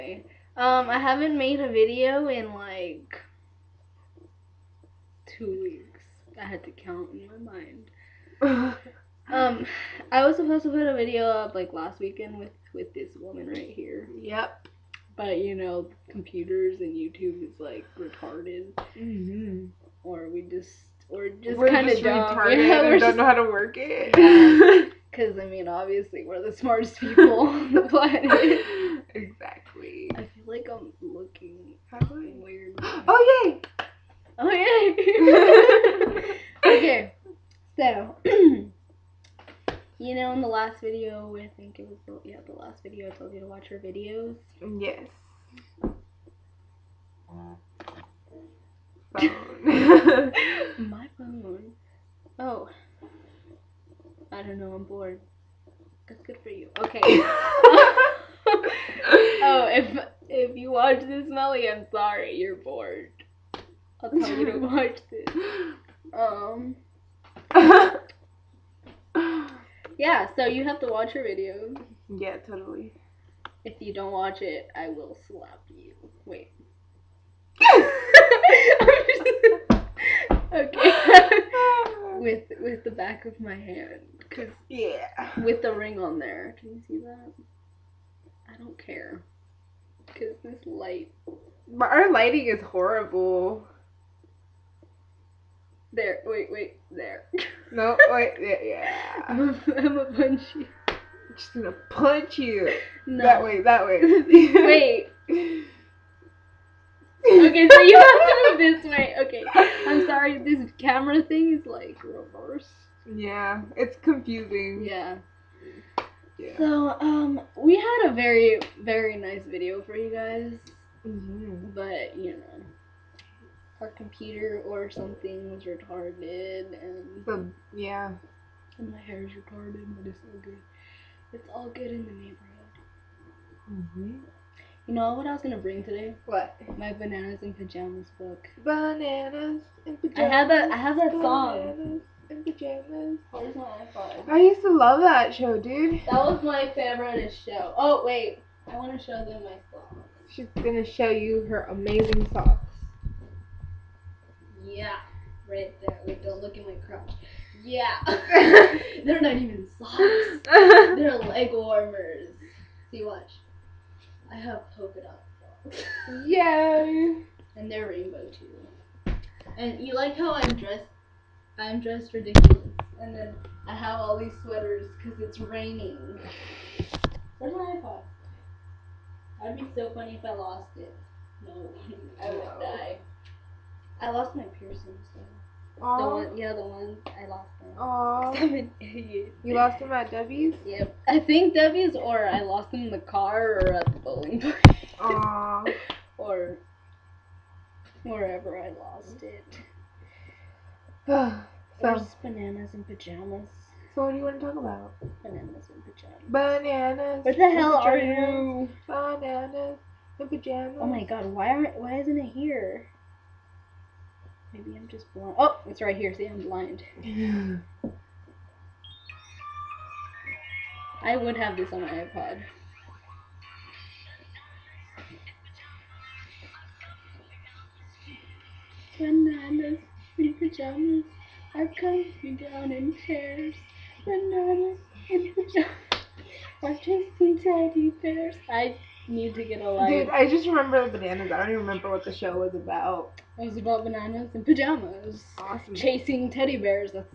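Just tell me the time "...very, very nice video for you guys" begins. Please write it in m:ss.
1:58.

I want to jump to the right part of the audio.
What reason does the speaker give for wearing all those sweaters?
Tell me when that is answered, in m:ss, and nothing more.
2:55.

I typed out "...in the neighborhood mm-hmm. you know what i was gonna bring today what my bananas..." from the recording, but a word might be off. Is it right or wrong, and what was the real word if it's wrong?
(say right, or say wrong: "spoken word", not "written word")
right.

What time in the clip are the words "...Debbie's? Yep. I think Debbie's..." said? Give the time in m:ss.
3:10.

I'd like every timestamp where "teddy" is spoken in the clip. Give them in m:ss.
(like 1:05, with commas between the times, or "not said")
3:57, 4:06.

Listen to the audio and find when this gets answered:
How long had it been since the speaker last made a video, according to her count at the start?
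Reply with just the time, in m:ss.
0:05.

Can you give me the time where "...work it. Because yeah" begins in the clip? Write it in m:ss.
0:23.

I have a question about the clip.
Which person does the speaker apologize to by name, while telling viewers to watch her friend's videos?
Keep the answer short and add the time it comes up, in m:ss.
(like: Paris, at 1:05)
Melly, at 1:01.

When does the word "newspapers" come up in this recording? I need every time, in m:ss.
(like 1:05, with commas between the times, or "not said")
not said.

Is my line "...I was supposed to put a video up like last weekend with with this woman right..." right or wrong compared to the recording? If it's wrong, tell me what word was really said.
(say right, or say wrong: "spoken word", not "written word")
right.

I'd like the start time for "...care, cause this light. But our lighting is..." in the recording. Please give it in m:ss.
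1:28.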